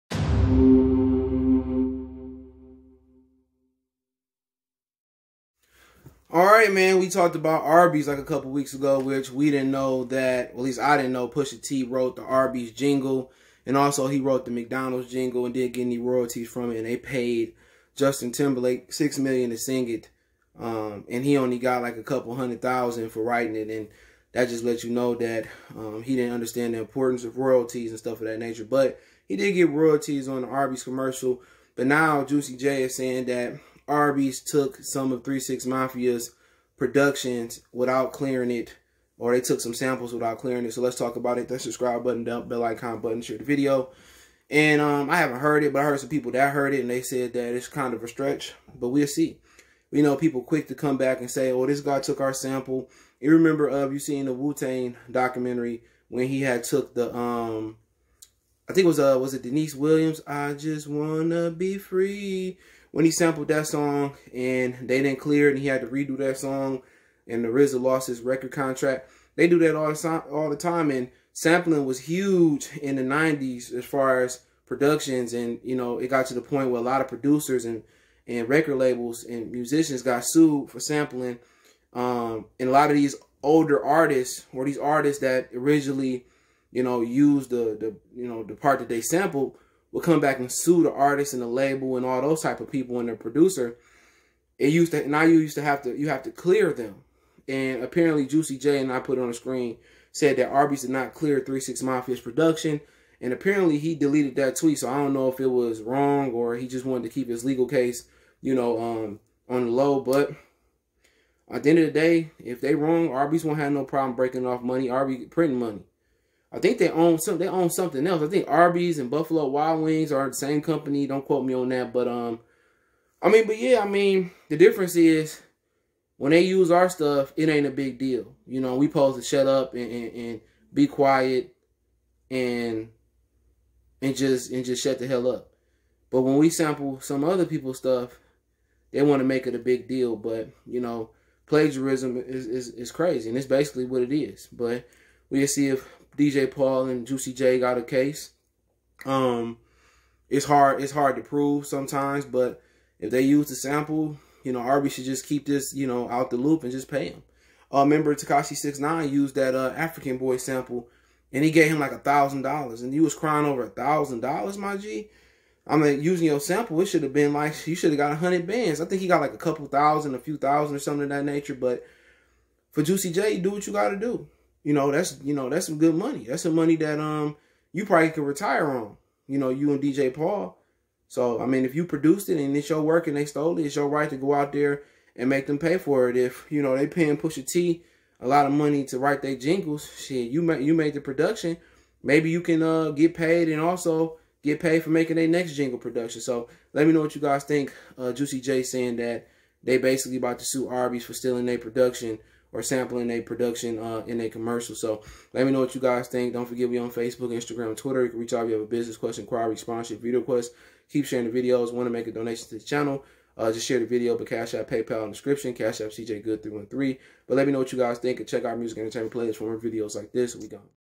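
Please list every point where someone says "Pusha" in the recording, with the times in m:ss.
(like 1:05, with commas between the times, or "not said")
0:11, 3:07.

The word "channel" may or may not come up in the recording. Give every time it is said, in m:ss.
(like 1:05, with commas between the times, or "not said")
3:32.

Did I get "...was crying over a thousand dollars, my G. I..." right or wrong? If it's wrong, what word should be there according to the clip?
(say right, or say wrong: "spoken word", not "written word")
right.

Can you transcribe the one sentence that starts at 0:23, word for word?
And that just lets you know that um, he didn't understand the importance of royalties and stuff of that nature.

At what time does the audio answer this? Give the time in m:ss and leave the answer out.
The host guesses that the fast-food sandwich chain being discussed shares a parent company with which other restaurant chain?
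1:59.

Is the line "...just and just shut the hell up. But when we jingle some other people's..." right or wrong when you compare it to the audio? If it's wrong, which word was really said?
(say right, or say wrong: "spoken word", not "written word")
wrong: "sample", not "jingle".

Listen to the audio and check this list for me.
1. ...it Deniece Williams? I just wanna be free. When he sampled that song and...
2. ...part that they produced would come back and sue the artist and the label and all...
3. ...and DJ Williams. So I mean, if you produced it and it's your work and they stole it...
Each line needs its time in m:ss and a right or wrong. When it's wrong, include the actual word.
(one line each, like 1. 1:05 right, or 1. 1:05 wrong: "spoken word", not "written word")
1. 0:59 right
2. 1:28 wrong: "sampled", not "produced"
3. 2:59 wrong: "Paul", not "Williams".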